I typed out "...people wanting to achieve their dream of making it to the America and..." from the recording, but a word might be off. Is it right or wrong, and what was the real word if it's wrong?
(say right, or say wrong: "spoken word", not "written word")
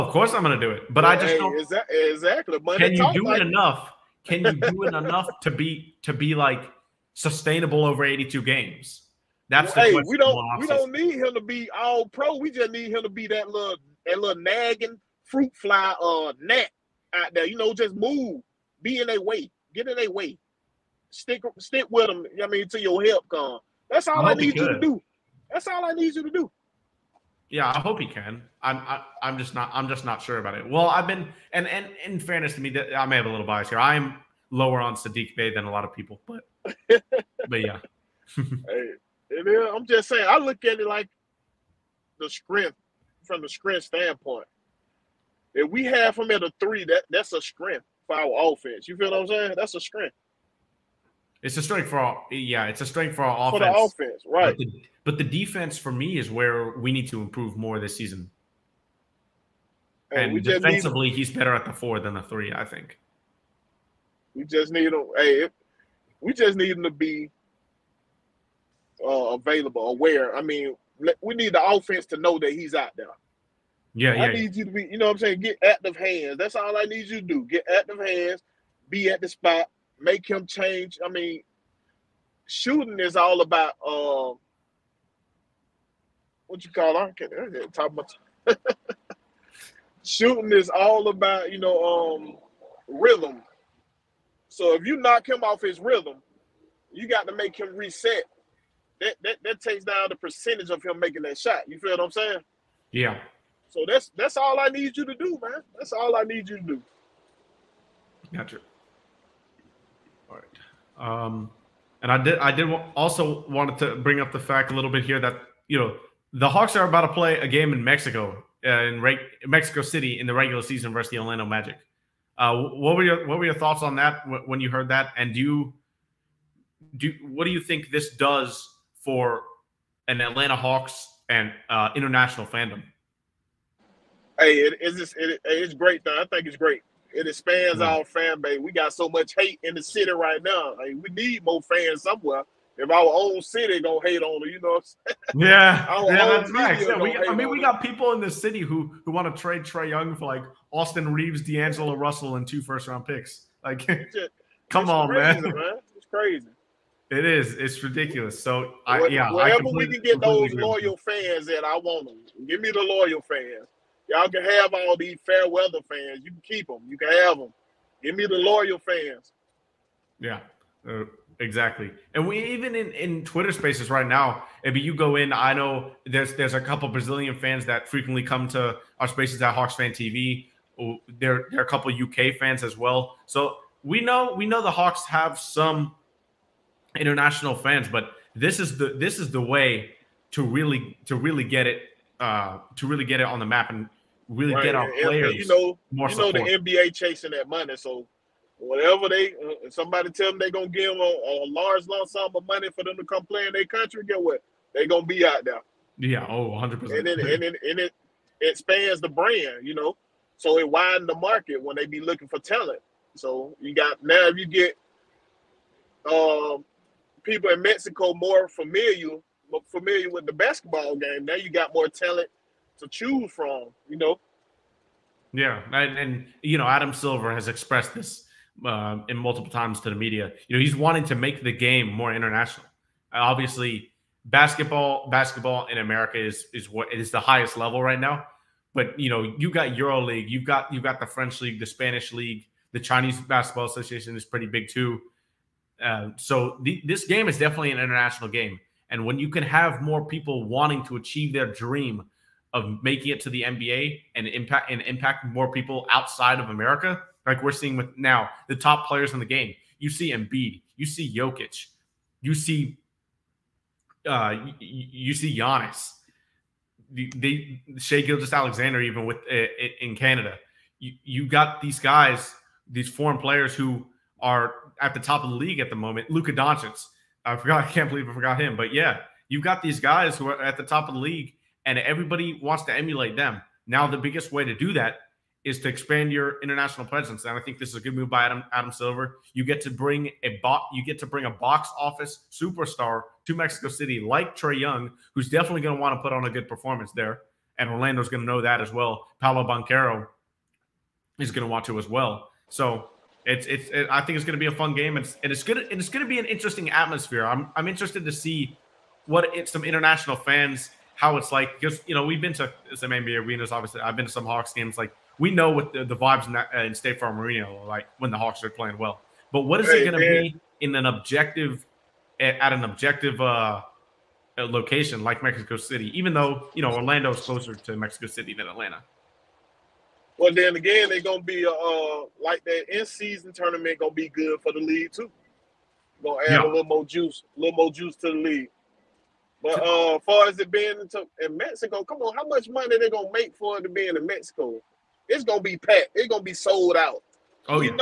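wrong: "NBA", not "America".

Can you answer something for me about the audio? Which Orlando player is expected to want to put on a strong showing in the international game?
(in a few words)
Paolo Banchero.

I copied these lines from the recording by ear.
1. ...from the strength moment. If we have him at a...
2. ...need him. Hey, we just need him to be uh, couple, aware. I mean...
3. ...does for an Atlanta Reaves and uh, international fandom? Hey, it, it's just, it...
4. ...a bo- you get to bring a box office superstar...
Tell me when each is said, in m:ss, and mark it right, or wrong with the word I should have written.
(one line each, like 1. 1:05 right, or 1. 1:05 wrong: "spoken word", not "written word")
1. 0:43 wrong: "standpoint", not "moment"
2. 1:04 wrong: "available", not "couple"
3. 2:08 wrong: "Hawks", not "Reaves"
4. 4:50 right.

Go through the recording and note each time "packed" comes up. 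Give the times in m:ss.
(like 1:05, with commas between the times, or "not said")
5:45.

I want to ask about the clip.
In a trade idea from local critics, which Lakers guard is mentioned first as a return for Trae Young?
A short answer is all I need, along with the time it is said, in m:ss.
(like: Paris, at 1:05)
Austin Reaves, at 2:30.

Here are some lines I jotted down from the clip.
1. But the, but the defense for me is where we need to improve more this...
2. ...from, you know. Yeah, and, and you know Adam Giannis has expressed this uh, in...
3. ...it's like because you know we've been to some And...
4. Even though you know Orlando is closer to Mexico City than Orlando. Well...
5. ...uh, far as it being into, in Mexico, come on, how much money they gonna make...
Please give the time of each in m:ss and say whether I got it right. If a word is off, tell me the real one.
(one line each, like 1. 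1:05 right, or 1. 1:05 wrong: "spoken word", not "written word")
1. 0:54 right
2. 3:43 wrong: "Silver", not "Giannis"
3. 5:11 wrong: "NBA", not "And"
4. 5:25 wrong: "Atlanta", not "Orlando"
5. 5:39 right.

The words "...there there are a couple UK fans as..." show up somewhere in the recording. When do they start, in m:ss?
3:01.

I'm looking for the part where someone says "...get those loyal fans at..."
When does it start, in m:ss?
2:39.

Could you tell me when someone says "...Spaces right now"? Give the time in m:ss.
2:53.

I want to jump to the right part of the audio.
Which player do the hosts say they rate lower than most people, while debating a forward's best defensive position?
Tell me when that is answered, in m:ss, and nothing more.
0:34.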